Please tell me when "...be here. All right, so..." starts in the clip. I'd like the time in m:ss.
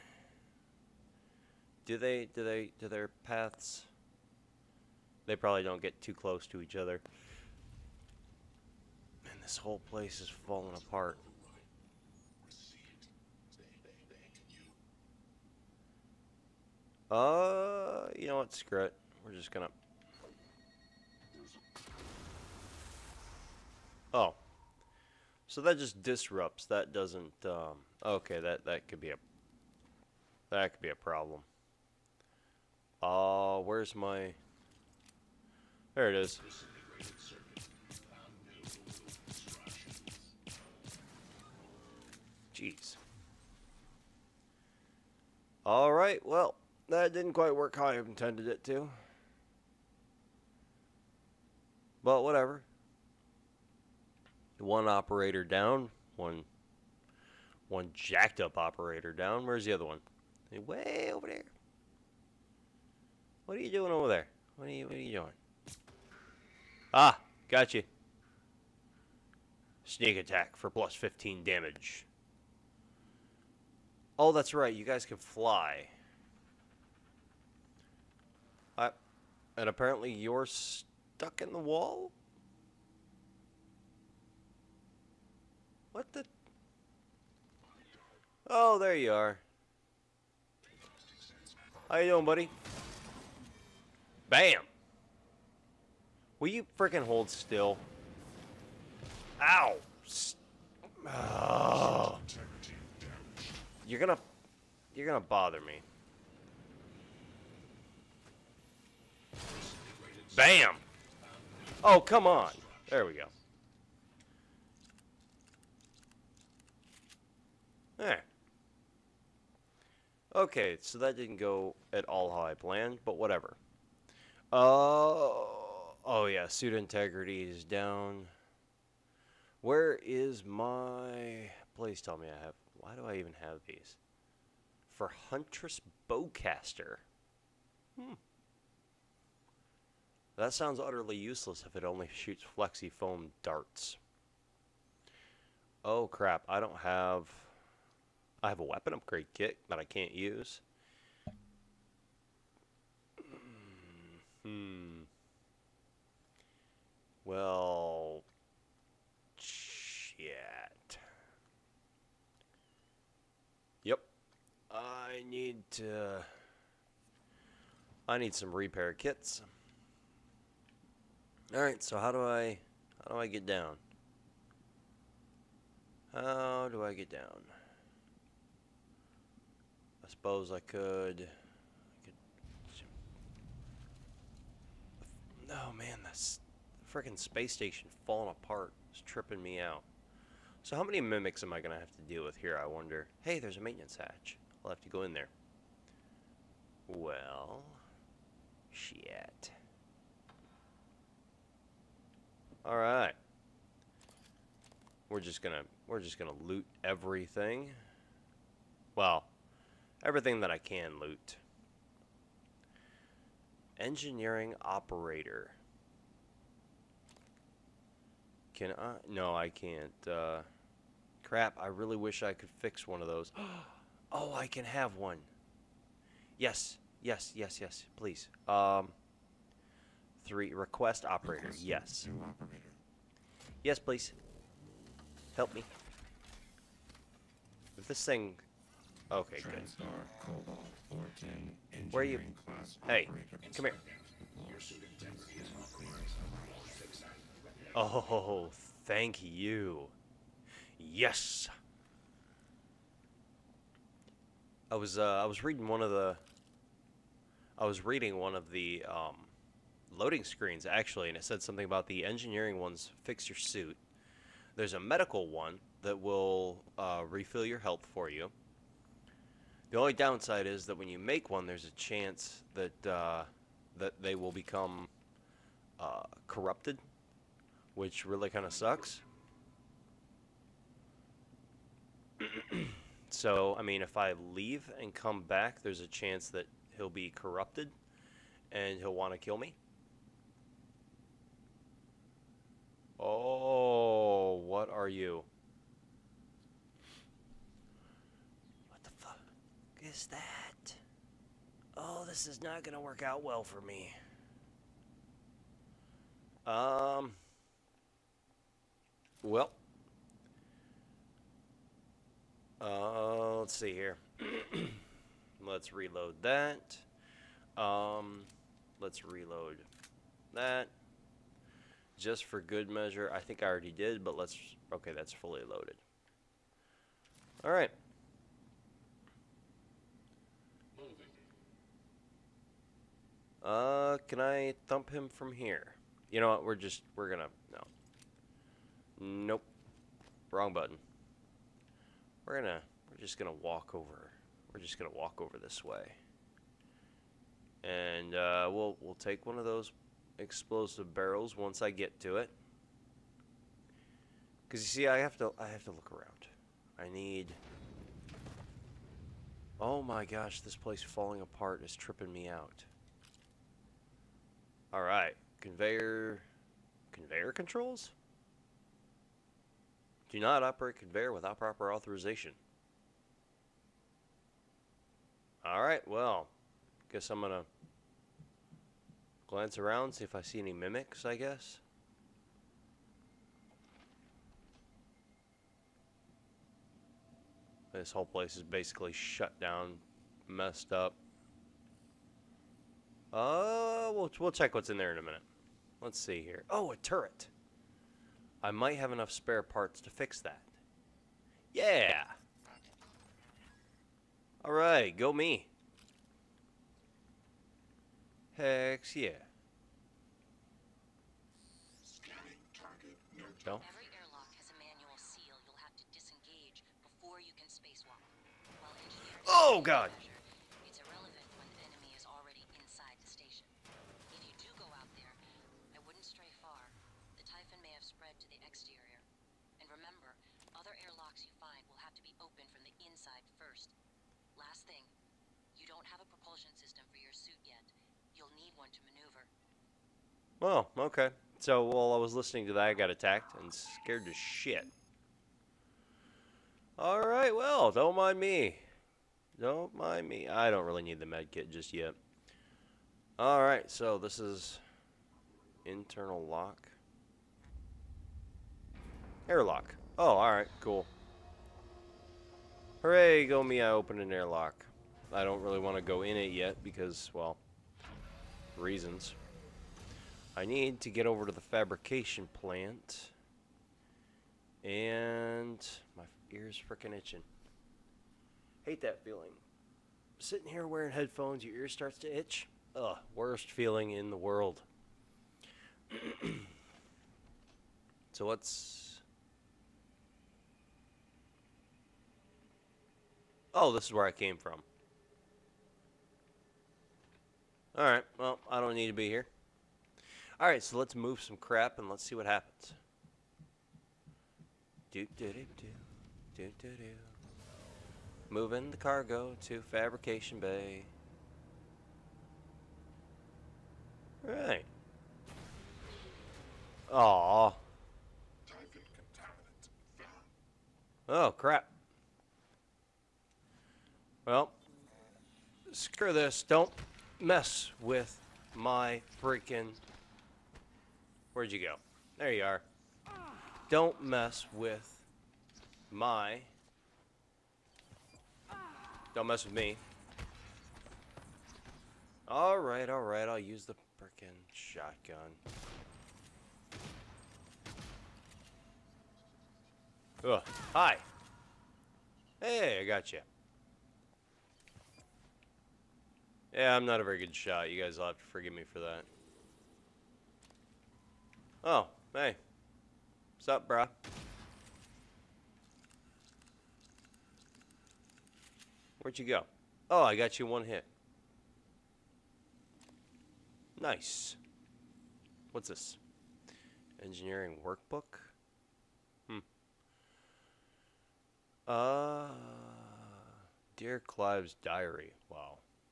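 8:18.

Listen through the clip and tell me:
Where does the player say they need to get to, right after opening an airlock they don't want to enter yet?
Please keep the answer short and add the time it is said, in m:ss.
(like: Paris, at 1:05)
Fabrication plant, at 7:51.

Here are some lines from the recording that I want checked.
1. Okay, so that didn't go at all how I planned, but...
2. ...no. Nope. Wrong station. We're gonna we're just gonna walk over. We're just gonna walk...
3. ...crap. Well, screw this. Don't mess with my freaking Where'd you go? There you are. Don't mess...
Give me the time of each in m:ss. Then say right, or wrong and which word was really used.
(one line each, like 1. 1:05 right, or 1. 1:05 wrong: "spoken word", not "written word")
1. 2:00 right
2. 5:37 wrong: "button", not "station"
3. 8:41 right.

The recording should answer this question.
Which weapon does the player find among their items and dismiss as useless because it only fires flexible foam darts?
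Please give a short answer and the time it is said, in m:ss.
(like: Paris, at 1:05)
Huntress Bowcaster, at 2:15.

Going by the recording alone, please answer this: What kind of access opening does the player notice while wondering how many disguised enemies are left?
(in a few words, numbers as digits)
Maintenance hatch.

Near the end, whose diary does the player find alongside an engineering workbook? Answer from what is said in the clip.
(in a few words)
Clive.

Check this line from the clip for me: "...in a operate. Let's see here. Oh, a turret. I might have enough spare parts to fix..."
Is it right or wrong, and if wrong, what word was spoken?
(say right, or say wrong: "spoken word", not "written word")
wrong: "minute", not "operate".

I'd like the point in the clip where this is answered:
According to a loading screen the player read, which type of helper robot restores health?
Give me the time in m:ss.
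4:24.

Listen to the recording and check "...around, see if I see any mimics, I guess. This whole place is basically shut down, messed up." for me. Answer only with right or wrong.
right.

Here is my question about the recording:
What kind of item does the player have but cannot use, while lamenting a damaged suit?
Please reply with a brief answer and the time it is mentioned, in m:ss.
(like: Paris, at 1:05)
Weapon upgrade kit, at 2:28.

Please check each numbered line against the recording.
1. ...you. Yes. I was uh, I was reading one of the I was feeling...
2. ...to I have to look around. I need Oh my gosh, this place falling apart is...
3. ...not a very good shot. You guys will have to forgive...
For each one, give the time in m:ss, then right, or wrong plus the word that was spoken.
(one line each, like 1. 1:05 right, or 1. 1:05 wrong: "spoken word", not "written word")
1. 4:09 wrong: "reading", not "feeling"
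2. 5:55 right
3. 9:16 right.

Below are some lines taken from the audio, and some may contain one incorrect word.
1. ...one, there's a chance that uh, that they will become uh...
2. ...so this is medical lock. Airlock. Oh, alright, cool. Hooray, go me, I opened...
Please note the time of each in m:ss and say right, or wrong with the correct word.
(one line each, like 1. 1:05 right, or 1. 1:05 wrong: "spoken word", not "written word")
1. 4:31 right
2. 7:33 wrong: "internal", not "medical".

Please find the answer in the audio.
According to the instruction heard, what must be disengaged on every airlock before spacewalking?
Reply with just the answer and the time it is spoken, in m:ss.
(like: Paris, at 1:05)
Manual seal, at 6:54.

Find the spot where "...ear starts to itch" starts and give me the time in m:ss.
8:01.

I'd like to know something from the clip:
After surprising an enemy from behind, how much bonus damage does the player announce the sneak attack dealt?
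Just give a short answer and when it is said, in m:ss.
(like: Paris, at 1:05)
15, at 1:10.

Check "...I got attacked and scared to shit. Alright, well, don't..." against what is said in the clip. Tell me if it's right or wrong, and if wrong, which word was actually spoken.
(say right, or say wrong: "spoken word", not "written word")
right.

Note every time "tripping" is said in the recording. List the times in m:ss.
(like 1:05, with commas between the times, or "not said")
3:09, 6:01.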